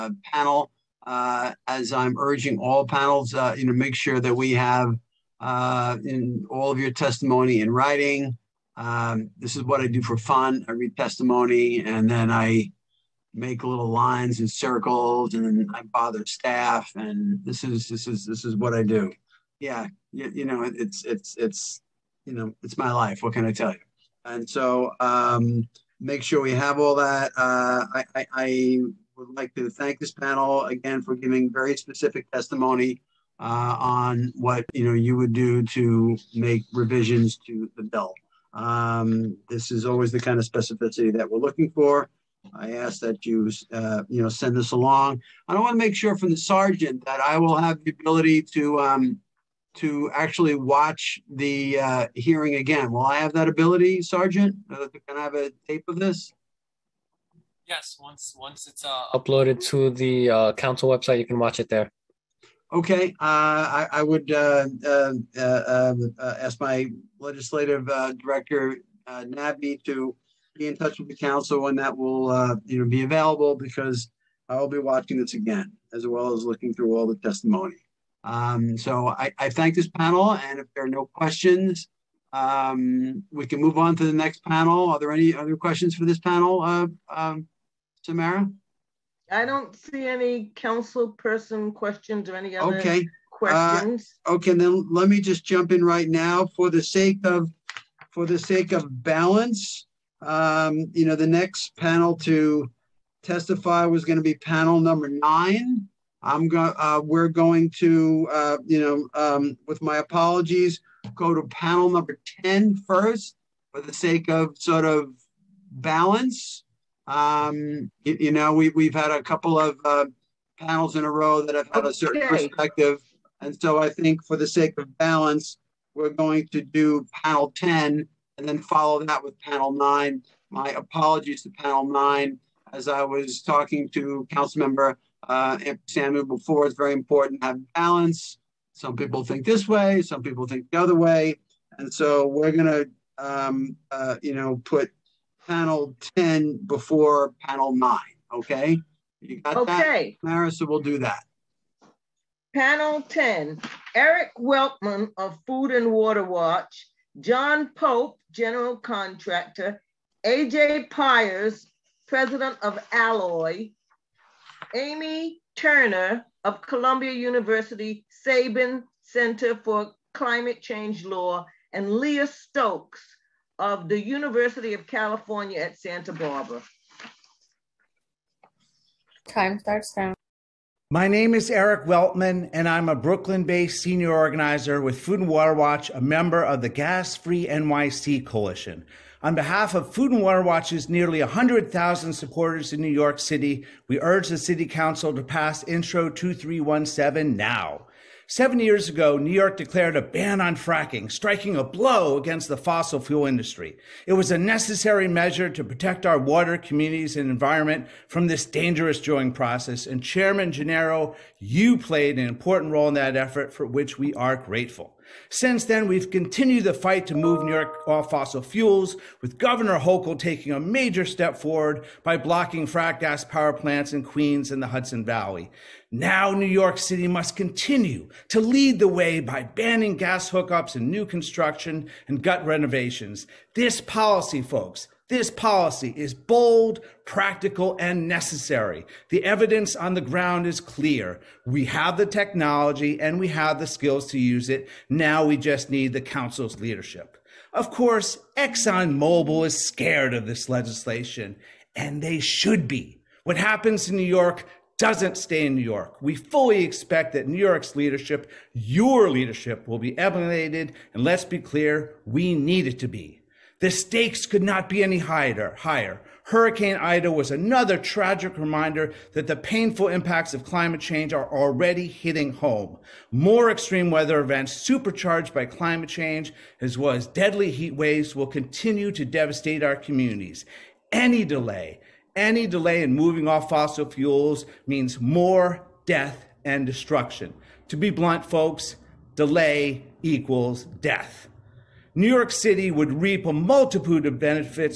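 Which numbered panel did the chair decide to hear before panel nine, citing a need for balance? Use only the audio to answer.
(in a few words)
Panel 10.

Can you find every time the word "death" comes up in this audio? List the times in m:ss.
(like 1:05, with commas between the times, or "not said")
4:45, 4:50.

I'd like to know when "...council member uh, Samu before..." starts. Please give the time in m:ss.
2:14.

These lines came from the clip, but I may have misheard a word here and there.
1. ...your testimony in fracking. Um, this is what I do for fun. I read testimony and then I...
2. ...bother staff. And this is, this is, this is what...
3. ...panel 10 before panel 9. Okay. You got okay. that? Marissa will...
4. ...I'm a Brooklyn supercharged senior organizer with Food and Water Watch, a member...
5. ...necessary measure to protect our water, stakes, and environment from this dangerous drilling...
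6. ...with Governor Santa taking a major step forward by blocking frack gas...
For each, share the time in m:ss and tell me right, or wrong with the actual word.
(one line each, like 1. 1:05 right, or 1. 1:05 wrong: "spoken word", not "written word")
1. 0:06 wrong: "writing", not "fracking"
2. 0:15 right
3. 2:25 right
4. 3:02 wrong: "based", not "supercharged"
5. 3:24 wrong: "communities", not "stakes"
6. 3:39 wrong: "Hochul", not "Santa".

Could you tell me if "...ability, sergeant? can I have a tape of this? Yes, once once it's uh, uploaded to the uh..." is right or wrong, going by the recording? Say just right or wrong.
right.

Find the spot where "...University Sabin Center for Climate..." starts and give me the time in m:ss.
2:47.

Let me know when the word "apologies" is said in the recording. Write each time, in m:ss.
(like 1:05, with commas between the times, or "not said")
1:49, 2:10.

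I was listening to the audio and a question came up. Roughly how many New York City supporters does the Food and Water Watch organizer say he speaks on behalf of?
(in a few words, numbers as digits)
100,000.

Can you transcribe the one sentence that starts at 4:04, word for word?
Now we just need the council's leadership.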